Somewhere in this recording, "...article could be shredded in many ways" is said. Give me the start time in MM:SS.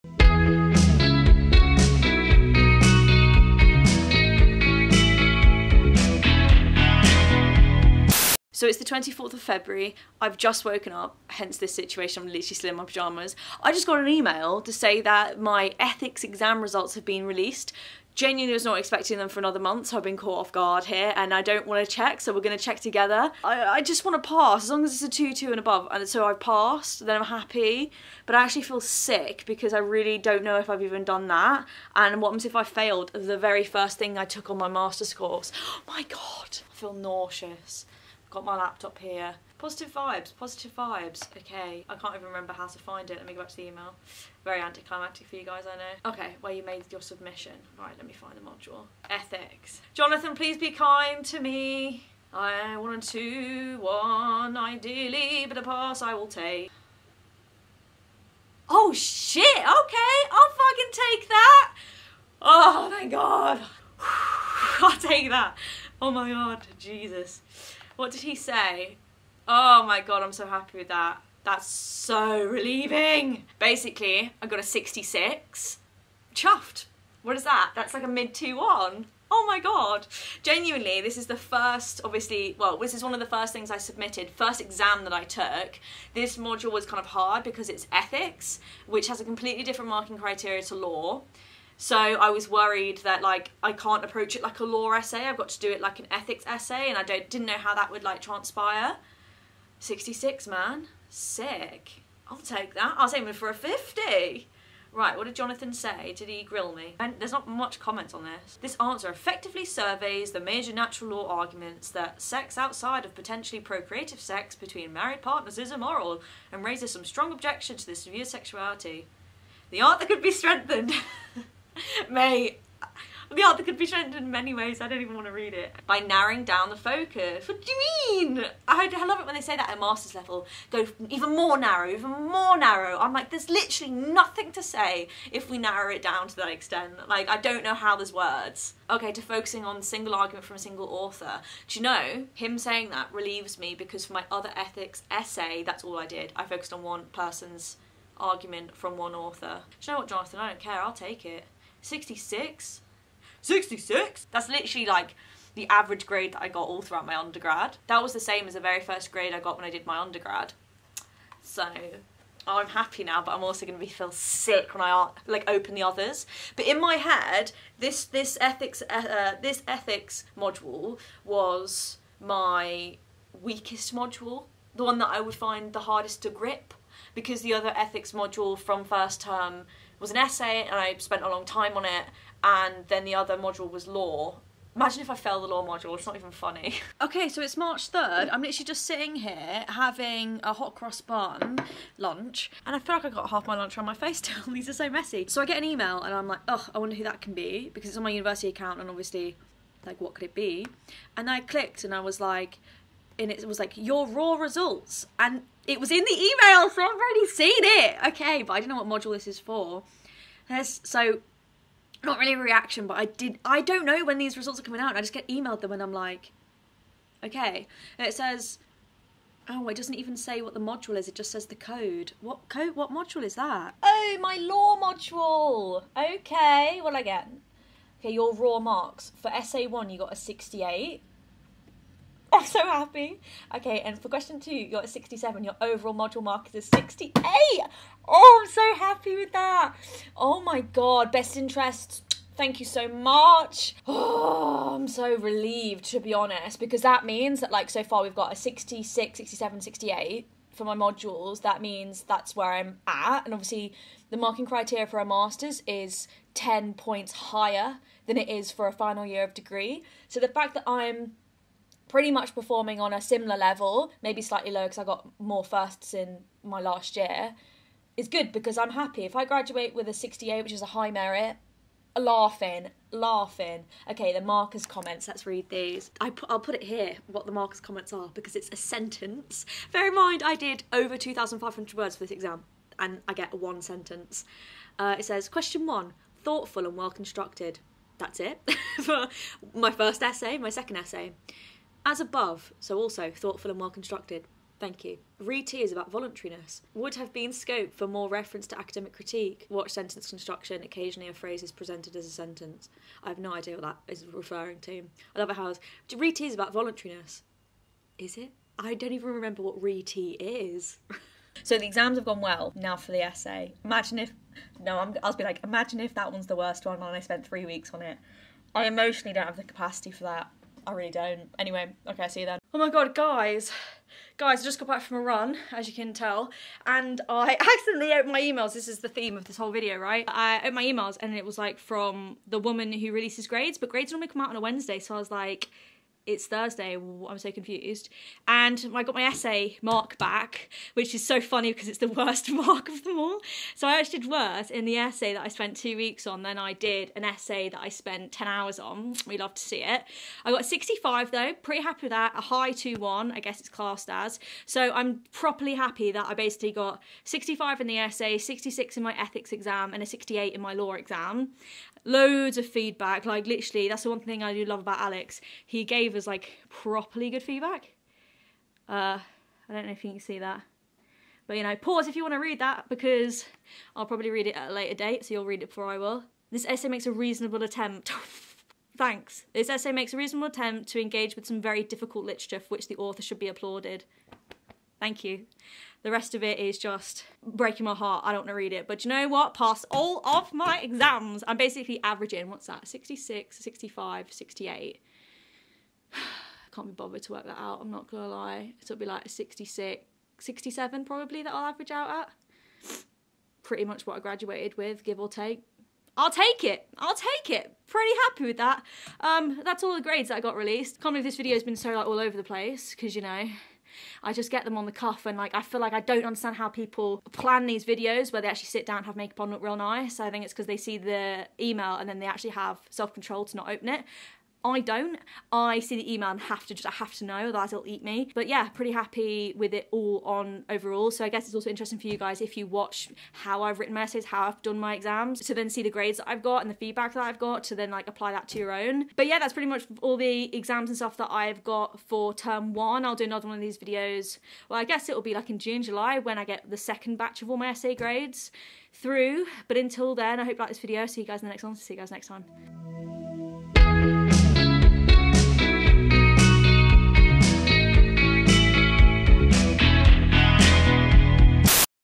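02:03.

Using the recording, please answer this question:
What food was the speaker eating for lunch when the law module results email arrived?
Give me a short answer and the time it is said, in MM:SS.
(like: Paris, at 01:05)
hot cross bun, at 03:10.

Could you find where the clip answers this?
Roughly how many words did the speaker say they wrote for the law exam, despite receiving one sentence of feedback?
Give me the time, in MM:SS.
04:40.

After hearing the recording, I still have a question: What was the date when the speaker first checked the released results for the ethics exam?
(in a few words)
24th of February.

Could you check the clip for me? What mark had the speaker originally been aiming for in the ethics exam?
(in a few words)
50.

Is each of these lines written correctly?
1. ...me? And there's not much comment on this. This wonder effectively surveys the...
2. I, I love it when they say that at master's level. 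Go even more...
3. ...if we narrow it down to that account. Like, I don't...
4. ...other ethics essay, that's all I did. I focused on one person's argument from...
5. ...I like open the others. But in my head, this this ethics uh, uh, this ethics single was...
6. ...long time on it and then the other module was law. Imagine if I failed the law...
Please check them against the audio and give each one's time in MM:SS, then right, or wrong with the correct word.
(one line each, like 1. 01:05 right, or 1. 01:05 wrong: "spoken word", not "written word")
1. 01:46 wrong: "answer", not "wonder"
2. 02:08 right
3. 02:15 wrong: "extent", not "account"
4. 02:24 right
5. 02:44 wrong: "module", not "single"
6. 03:01 right.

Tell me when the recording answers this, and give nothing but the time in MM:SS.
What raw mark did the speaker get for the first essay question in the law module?
03:49.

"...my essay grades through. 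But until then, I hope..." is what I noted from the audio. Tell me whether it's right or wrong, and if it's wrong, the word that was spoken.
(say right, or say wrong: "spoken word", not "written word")
right.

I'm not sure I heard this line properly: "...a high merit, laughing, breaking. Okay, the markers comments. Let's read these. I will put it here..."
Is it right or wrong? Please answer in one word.
wrong.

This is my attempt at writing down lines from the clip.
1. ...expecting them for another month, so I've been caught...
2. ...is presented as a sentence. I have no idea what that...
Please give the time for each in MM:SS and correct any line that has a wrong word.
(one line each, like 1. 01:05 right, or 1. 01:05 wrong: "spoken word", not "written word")
1. 00:18 right
2. 05:01 right.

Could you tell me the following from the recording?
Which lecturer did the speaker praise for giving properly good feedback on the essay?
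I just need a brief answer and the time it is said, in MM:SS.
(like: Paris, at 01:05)
Alex, at 06:04.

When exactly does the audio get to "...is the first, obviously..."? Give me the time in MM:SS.
01:21.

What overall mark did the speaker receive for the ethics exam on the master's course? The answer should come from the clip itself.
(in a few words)
66.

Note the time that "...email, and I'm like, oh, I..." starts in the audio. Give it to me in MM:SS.
03:15.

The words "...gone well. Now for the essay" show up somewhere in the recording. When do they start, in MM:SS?
05:12.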